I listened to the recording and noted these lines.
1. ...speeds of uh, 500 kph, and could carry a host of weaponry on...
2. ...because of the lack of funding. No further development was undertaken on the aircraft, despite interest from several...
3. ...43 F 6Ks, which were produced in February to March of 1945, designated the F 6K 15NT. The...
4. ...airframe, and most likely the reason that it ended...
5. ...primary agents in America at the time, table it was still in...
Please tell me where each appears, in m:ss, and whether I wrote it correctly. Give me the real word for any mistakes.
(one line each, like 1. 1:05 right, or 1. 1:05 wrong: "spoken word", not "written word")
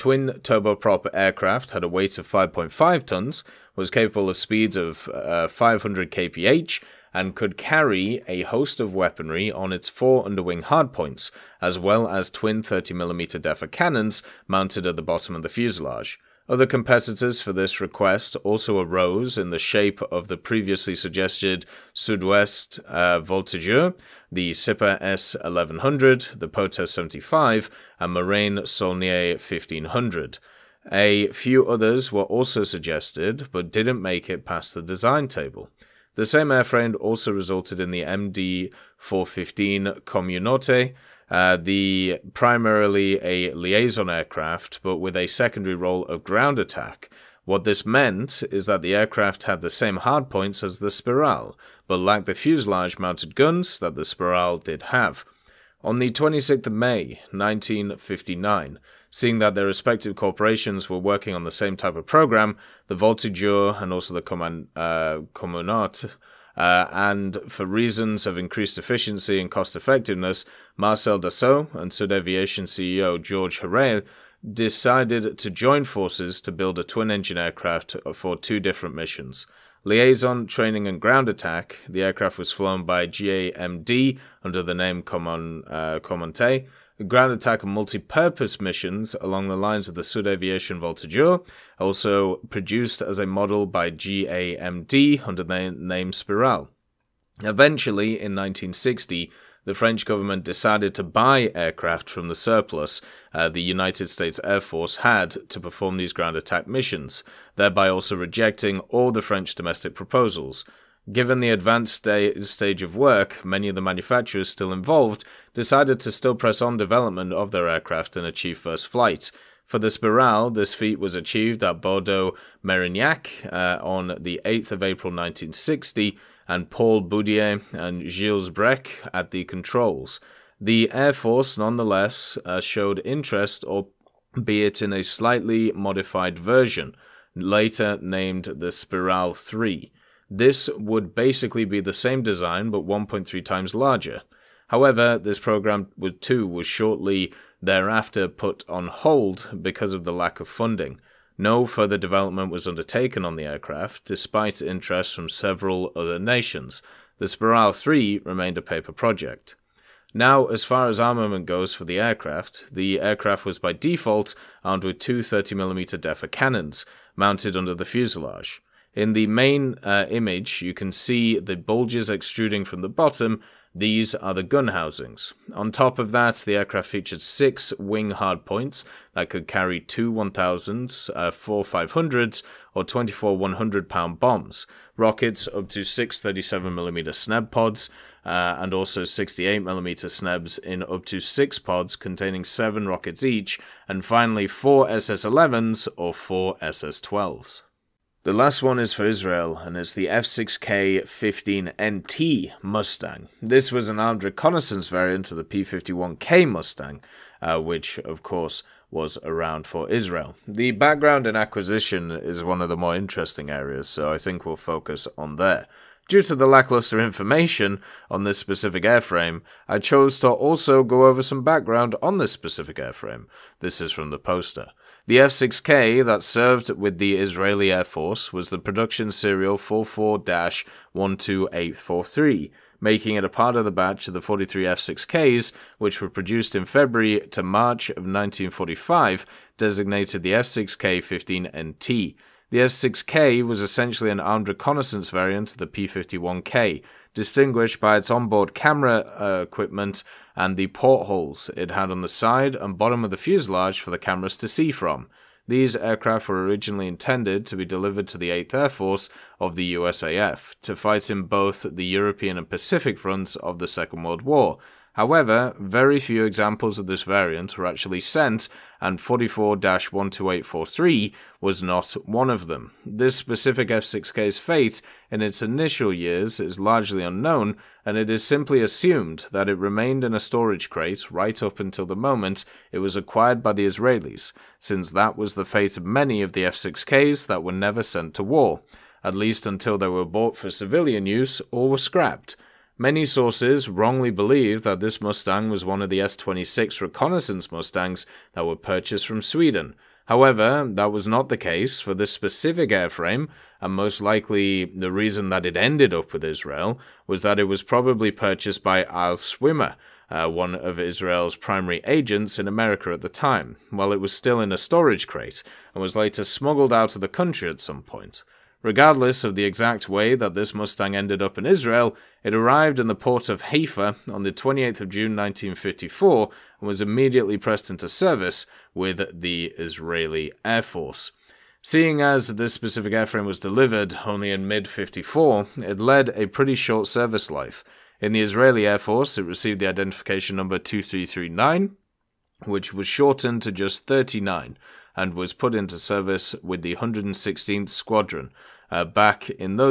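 1. 0:04 right
2. 2:29 right
3. 3:54 right
4. 5:02 right
5. 5:11 wrong: "while", not "table".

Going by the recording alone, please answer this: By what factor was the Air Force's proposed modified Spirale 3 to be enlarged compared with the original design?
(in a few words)
1.3 times.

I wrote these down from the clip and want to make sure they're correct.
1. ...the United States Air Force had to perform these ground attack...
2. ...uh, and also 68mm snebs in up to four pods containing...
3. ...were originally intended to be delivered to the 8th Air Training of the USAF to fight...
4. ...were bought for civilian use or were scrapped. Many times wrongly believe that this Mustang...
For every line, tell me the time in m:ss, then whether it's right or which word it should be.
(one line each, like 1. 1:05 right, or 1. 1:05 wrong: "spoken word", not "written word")
1. 1:43 right
2. 3:08 wrong: "six", not "four"
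3. 4:16 wrong: "Force", not "Training"
4. 4:49 wrong: "sources", not "times".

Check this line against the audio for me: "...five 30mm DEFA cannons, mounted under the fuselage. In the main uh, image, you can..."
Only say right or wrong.
wrong.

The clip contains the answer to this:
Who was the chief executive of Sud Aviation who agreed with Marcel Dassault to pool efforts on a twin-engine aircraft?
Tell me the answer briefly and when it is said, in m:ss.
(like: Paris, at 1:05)
George Héreil, at 1:13.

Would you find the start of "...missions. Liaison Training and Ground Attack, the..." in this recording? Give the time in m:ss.
1:18.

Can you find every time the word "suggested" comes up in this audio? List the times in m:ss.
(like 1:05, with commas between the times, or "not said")
0:20, 0:32.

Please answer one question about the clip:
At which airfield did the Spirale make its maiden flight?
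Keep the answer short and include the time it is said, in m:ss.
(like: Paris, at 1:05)
Bordeaux Merignac, at 2:01.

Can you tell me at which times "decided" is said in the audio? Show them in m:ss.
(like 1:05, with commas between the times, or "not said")
1:14, 1:40, 1:55.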